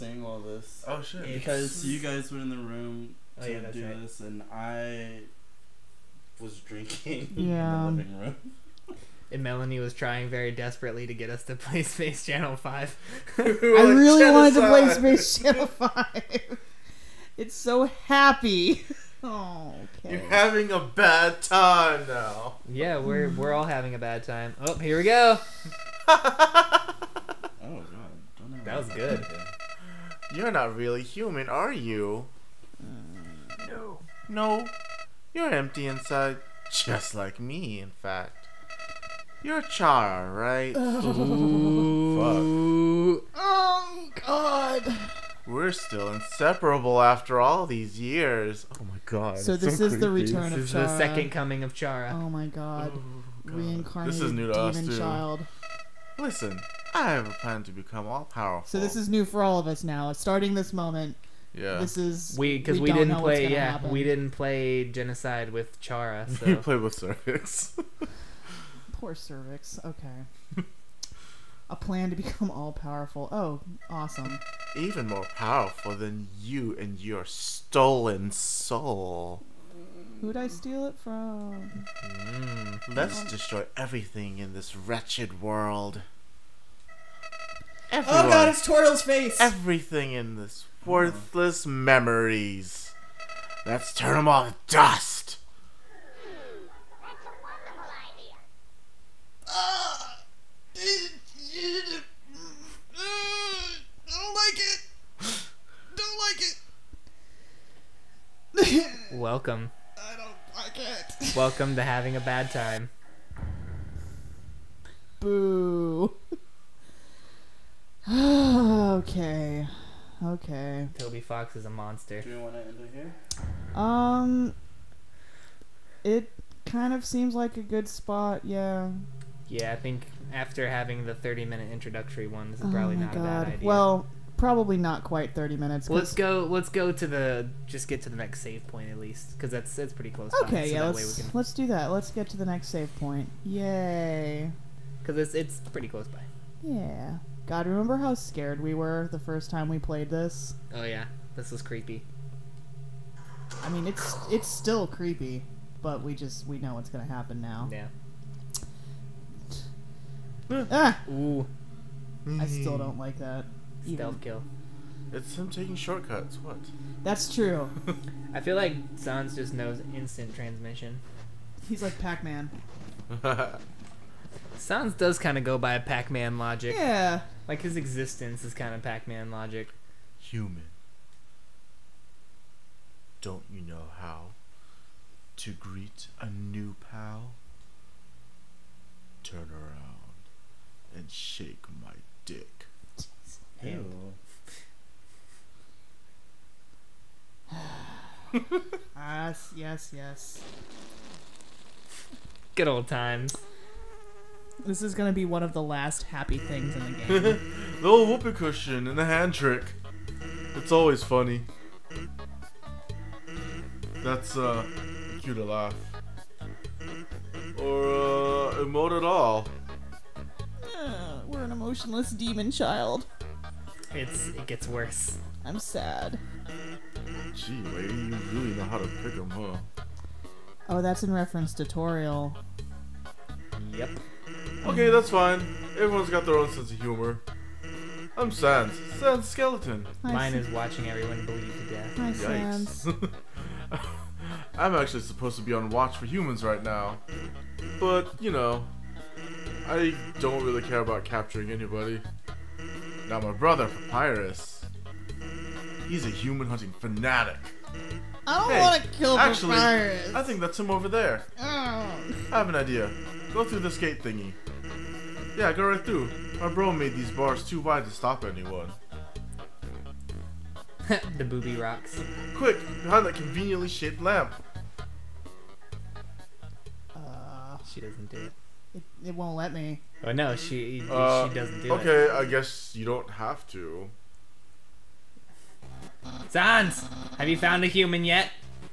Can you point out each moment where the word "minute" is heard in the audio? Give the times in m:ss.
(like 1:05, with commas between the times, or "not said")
2:11, 2:15.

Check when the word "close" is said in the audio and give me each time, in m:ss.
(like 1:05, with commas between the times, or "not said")
2:20, 2:25.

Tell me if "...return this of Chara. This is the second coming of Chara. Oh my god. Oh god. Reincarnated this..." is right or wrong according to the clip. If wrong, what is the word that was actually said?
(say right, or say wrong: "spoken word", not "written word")
right.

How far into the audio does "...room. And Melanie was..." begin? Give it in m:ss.
0:08.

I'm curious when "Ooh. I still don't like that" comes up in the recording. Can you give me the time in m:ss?
2:41.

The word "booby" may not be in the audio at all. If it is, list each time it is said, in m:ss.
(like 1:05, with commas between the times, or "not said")
4:31.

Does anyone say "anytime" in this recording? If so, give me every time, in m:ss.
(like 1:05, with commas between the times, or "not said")
not said.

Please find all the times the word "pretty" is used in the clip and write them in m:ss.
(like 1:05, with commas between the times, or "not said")
2:19, 2:25.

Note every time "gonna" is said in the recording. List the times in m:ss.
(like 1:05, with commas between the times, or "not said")
2:36, 3:24.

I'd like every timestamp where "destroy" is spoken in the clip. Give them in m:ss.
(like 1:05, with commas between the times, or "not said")
1:23.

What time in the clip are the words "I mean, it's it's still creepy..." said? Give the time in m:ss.
2:33.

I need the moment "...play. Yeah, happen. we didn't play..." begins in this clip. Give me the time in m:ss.
1:03.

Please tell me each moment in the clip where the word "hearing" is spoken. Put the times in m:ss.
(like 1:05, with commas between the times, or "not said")
not said.